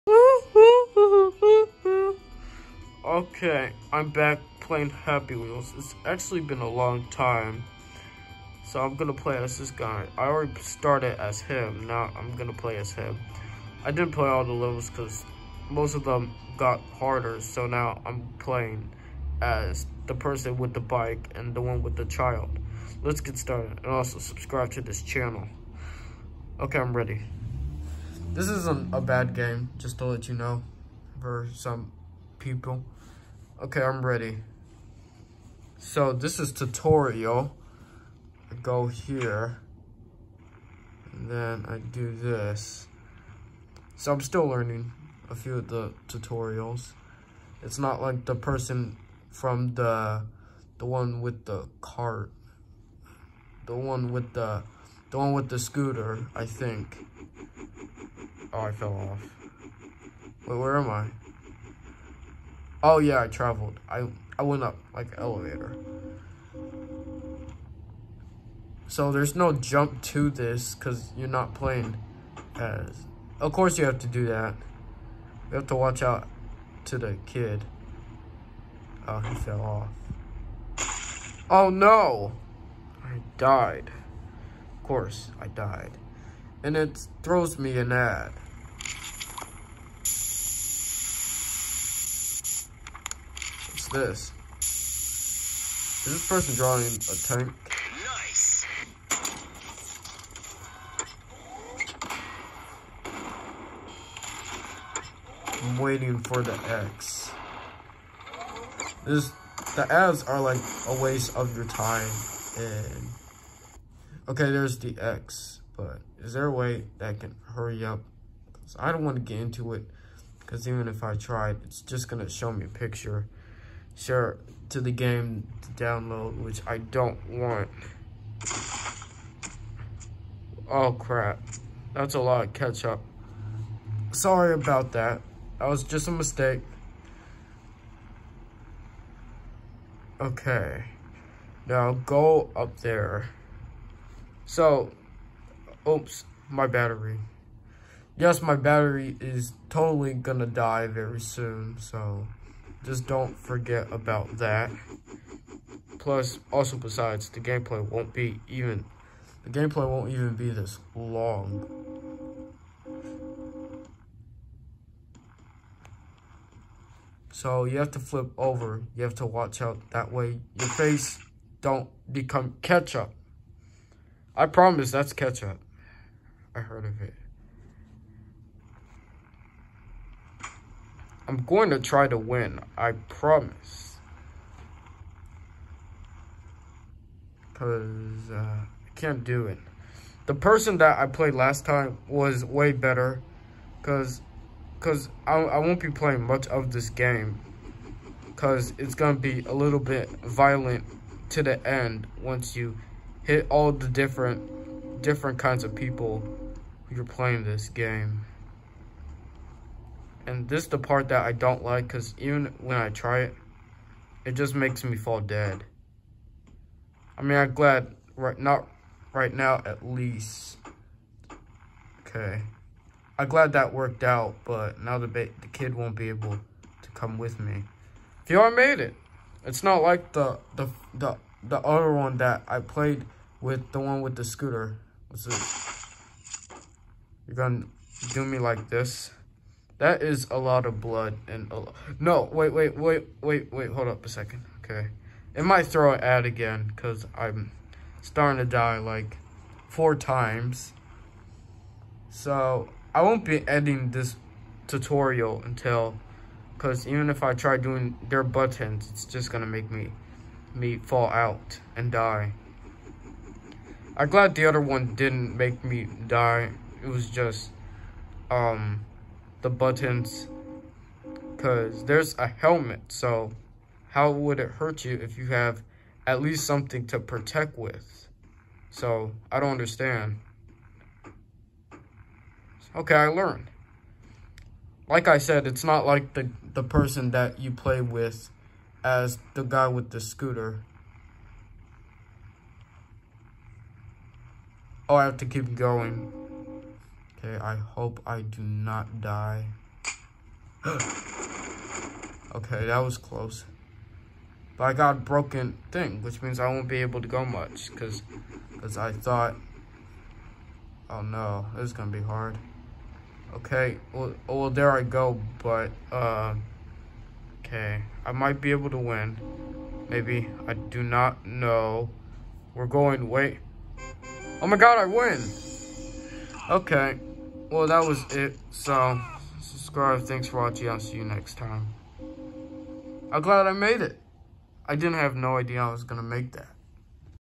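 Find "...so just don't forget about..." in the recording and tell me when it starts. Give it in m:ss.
2:31.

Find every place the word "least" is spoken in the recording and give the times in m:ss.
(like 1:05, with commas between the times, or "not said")
3:39, 4:36.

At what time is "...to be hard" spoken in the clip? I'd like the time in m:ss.
5:11.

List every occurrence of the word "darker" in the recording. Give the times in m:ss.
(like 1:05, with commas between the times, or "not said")
not said.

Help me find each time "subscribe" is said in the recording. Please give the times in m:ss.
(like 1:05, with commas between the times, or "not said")
0:24, 5:29.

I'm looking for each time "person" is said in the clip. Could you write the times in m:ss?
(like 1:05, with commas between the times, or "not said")
0:20, 0:48, 1:36, 3:10, 4:46.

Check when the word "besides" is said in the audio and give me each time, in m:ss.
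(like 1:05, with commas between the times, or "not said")
2:36.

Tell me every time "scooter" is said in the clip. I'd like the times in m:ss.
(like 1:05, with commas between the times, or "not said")
0:55, 3:54, 4:49.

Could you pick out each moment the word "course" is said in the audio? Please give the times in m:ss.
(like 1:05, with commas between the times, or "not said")
1:13, 1:24.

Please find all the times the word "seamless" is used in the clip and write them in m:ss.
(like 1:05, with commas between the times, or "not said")
not said.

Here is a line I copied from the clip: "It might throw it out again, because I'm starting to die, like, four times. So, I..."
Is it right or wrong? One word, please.
right.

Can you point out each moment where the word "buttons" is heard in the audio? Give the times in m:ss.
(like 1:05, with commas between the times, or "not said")
4:18, 4:29.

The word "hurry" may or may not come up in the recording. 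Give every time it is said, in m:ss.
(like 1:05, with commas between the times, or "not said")
1:57.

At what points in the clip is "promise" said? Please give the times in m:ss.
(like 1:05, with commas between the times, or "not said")
2:54, 3:02.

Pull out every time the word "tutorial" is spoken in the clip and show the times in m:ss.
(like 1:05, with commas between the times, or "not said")
0:36, 0:46, 4:14.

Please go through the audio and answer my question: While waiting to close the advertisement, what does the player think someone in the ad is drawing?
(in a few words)
a tank.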